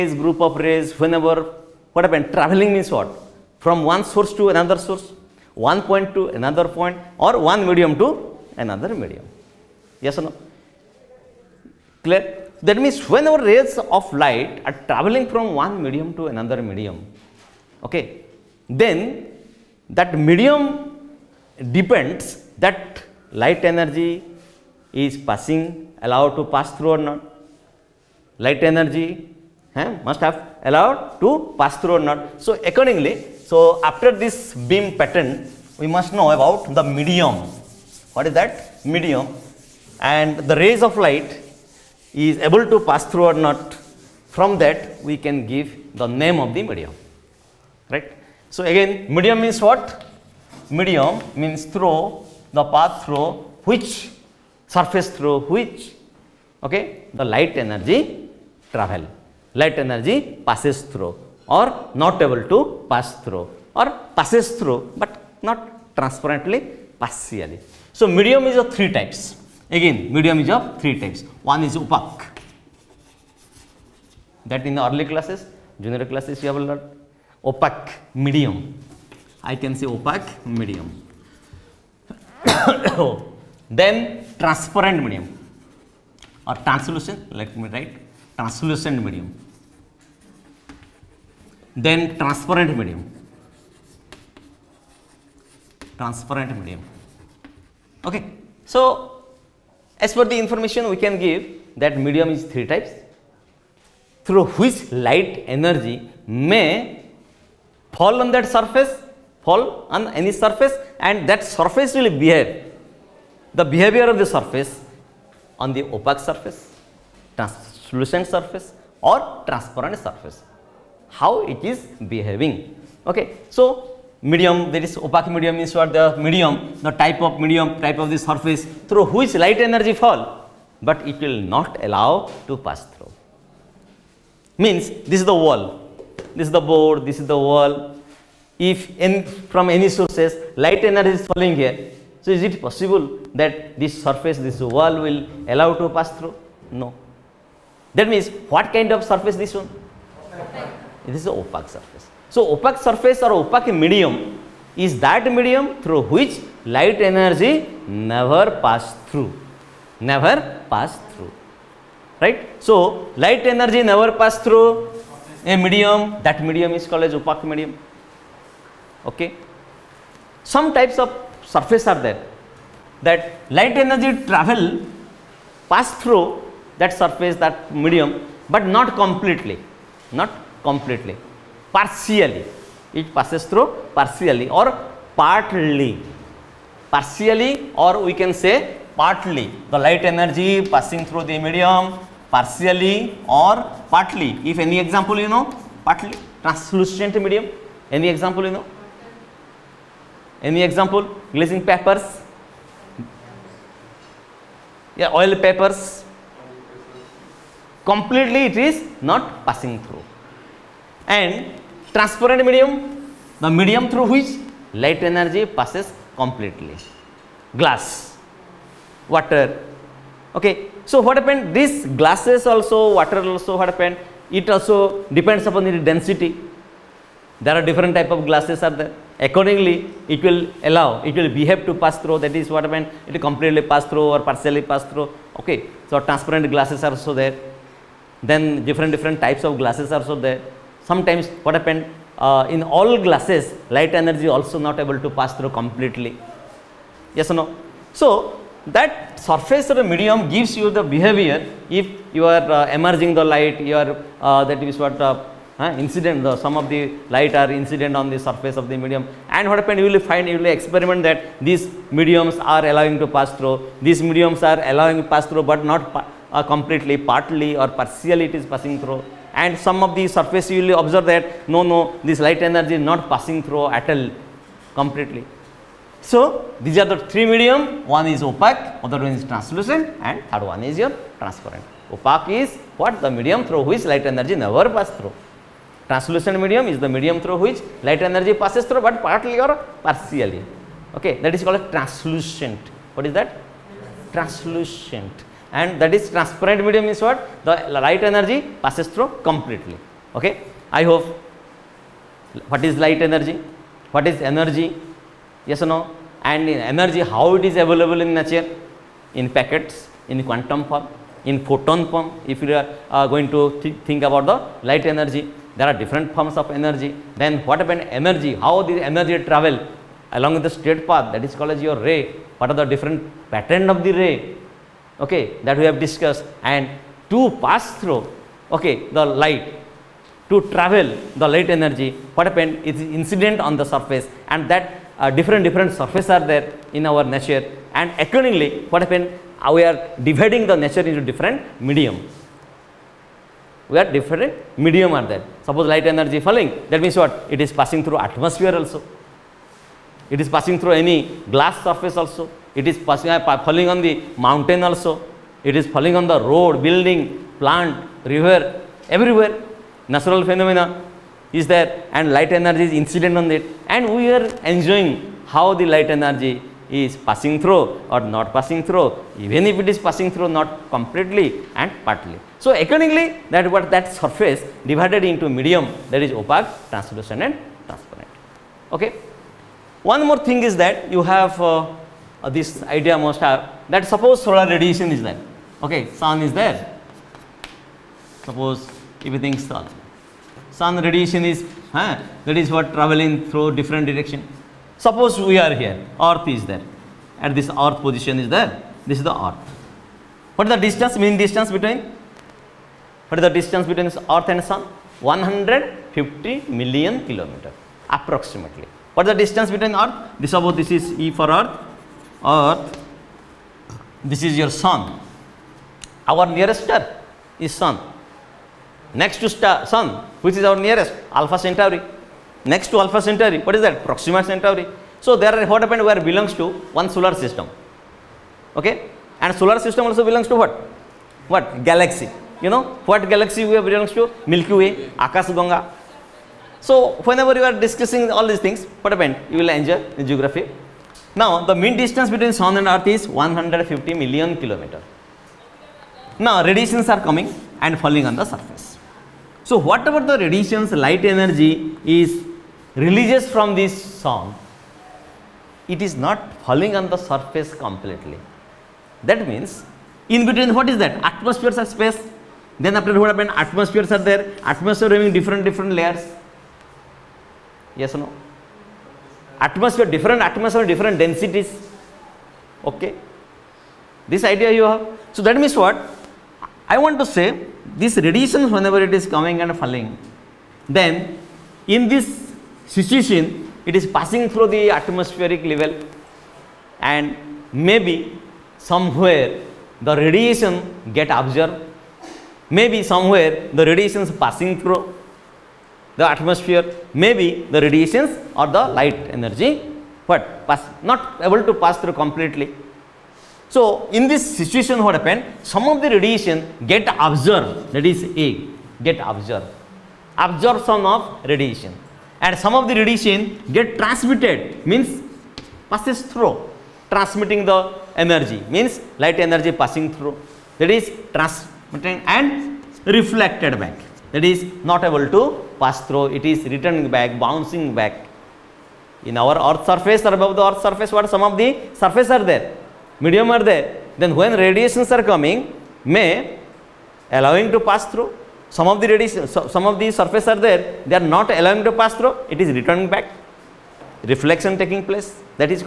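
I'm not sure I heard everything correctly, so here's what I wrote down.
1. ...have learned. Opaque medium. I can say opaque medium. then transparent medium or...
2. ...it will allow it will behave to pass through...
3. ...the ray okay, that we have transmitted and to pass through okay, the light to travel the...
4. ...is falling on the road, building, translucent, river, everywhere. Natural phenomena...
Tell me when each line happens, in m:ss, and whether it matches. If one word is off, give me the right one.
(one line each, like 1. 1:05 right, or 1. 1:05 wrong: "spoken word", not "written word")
1. 1:16 right
2. 3:50 right
3. 5:23 wrong: "discussed", not "transmitted"
4. 5:55 wrong: "plant", not "translucent".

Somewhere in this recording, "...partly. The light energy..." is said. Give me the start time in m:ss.
3:09.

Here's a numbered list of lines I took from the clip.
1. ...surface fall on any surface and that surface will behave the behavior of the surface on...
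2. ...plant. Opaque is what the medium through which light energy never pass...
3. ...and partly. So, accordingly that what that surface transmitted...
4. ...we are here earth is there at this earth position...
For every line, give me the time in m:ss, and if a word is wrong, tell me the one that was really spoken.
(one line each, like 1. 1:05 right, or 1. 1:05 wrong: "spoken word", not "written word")
1. 1:48 right
2. 4:41 wrong: "transparent", not "plant"
3. 6:11 wrong: "divided", not "transmitted"
4. 6:35 right.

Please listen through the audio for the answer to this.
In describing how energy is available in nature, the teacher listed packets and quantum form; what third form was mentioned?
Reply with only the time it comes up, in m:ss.
5:11.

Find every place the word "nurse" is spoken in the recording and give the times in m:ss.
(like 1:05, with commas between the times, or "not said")
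not said.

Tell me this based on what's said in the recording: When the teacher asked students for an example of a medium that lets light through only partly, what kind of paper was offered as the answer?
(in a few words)
Oil papers.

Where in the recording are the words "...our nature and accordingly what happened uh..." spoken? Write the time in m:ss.
5:36.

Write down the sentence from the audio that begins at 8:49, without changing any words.
In our earth surface or above the earth surface, what some of the surface are there?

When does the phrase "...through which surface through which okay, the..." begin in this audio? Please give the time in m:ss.
0:53.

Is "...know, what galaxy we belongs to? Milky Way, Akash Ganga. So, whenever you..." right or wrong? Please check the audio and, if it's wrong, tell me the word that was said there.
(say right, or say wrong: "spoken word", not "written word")
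right.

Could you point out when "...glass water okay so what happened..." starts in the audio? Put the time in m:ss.
3:37.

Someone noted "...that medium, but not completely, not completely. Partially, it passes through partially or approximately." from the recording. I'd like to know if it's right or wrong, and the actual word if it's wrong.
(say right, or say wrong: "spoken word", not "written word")
wrong: "partly", not "approximately".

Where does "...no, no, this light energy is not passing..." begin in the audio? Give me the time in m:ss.
4:31.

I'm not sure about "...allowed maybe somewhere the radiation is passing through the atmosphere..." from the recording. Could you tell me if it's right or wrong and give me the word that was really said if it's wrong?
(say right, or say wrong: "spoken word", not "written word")
wrong: "observed", not "allowed".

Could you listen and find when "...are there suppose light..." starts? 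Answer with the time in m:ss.
5:44.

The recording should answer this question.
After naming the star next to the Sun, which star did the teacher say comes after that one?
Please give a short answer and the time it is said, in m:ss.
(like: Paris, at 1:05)
Proxima Centauri, at 7:03.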